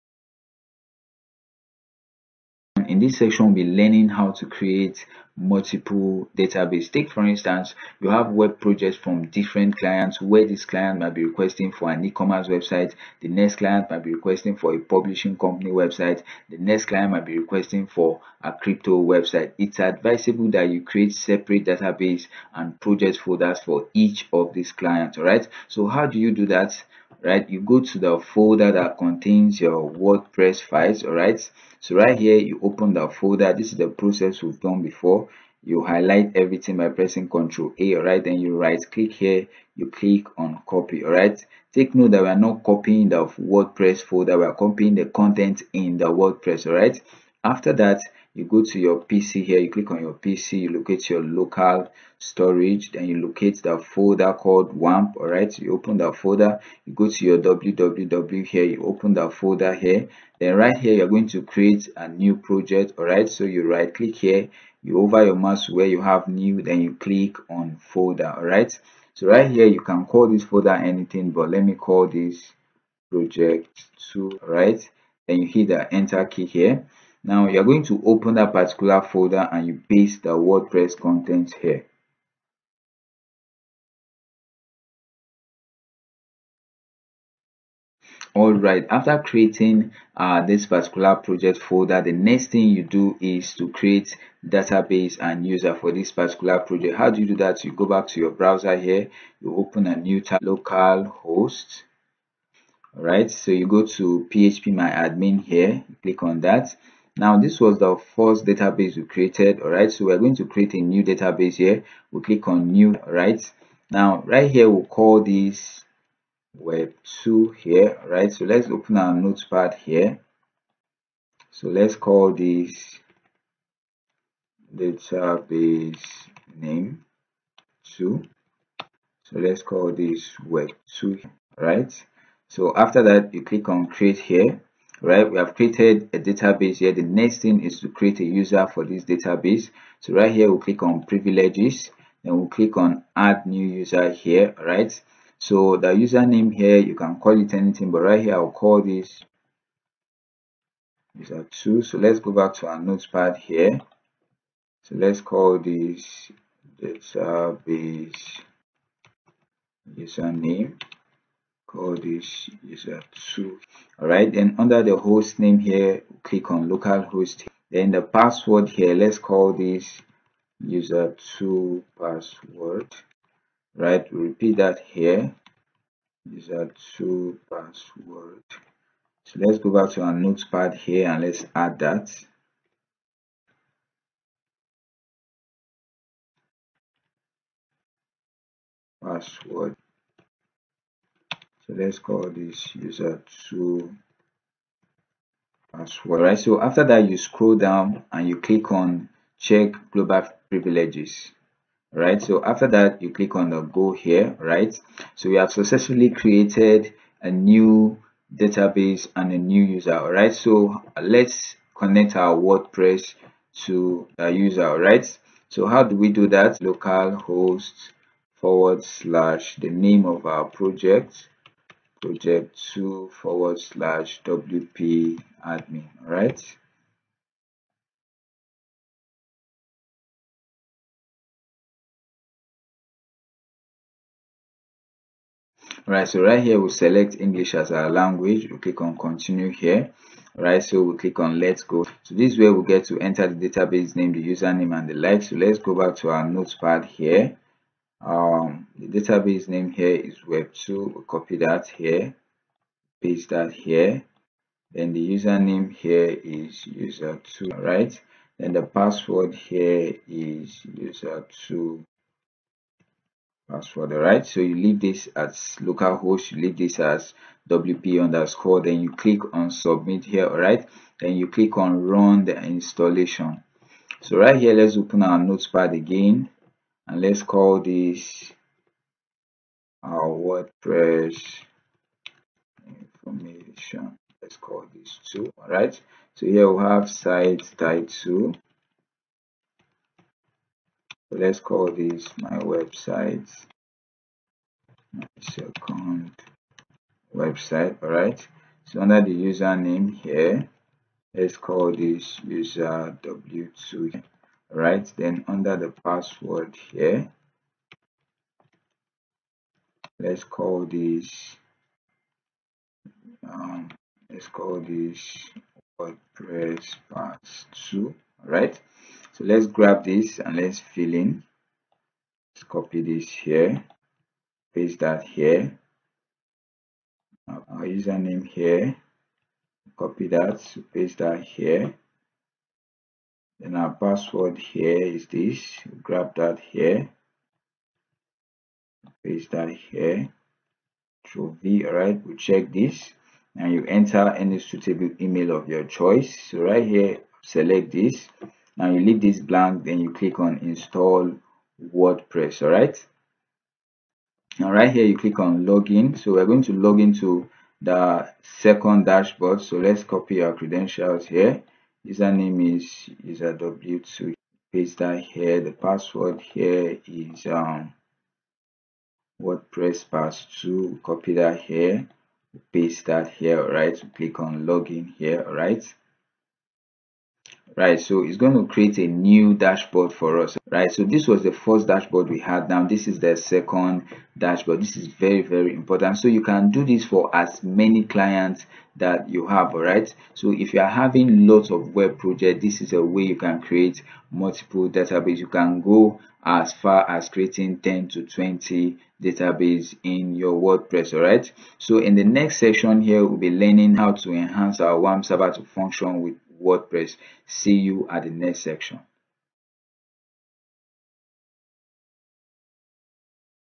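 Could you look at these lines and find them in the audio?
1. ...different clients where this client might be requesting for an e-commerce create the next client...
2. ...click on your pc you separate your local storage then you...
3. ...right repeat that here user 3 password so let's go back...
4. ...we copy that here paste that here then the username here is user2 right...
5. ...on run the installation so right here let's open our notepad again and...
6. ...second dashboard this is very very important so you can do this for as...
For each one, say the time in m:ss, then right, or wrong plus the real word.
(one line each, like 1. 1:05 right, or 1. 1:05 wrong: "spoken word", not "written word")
1. 0:09 wrong: "website", not "create"
2. 0:49 wrong: "locate", not "separate"
3. 2:53 wrong: "2", not "3"
4. 4:10 right
5. 4:31 right
6. 6:23 right.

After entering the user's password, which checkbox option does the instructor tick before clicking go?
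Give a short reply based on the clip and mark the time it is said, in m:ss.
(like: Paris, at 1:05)
check global privileges, at 3:19.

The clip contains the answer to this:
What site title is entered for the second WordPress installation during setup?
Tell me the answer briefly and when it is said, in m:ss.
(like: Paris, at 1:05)
my second website, at 4:54.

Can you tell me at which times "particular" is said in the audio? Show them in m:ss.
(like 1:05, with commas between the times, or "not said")
1:18, 1:30, 1:36.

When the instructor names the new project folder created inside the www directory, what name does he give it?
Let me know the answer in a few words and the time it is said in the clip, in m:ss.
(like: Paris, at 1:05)
project 2, at 1:13.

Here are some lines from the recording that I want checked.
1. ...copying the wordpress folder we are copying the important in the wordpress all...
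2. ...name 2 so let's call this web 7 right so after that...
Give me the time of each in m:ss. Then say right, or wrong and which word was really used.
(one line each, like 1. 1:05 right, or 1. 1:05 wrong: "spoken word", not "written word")
1. 0:42 wrong: "content", not "important"
2. 2:06 wrong: "2", not "7".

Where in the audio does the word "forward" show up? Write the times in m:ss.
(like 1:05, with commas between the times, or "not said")
3:38, 3:43.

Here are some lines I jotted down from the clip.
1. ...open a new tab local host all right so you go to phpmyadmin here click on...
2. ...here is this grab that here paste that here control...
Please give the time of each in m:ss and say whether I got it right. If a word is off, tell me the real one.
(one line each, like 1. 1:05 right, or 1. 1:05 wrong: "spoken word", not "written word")
1. 1:39 right
2. 5:34 right.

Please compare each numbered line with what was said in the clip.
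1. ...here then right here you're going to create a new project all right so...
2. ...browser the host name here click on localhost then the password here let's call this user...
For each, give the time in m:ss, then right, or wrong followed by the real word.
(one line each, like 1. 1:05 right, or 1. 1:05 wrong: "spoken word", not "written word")
1. 0:59 right
2. 2:44 wrong: "under", not "browser".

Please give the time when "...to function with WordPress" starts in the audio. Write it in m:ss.
6:45.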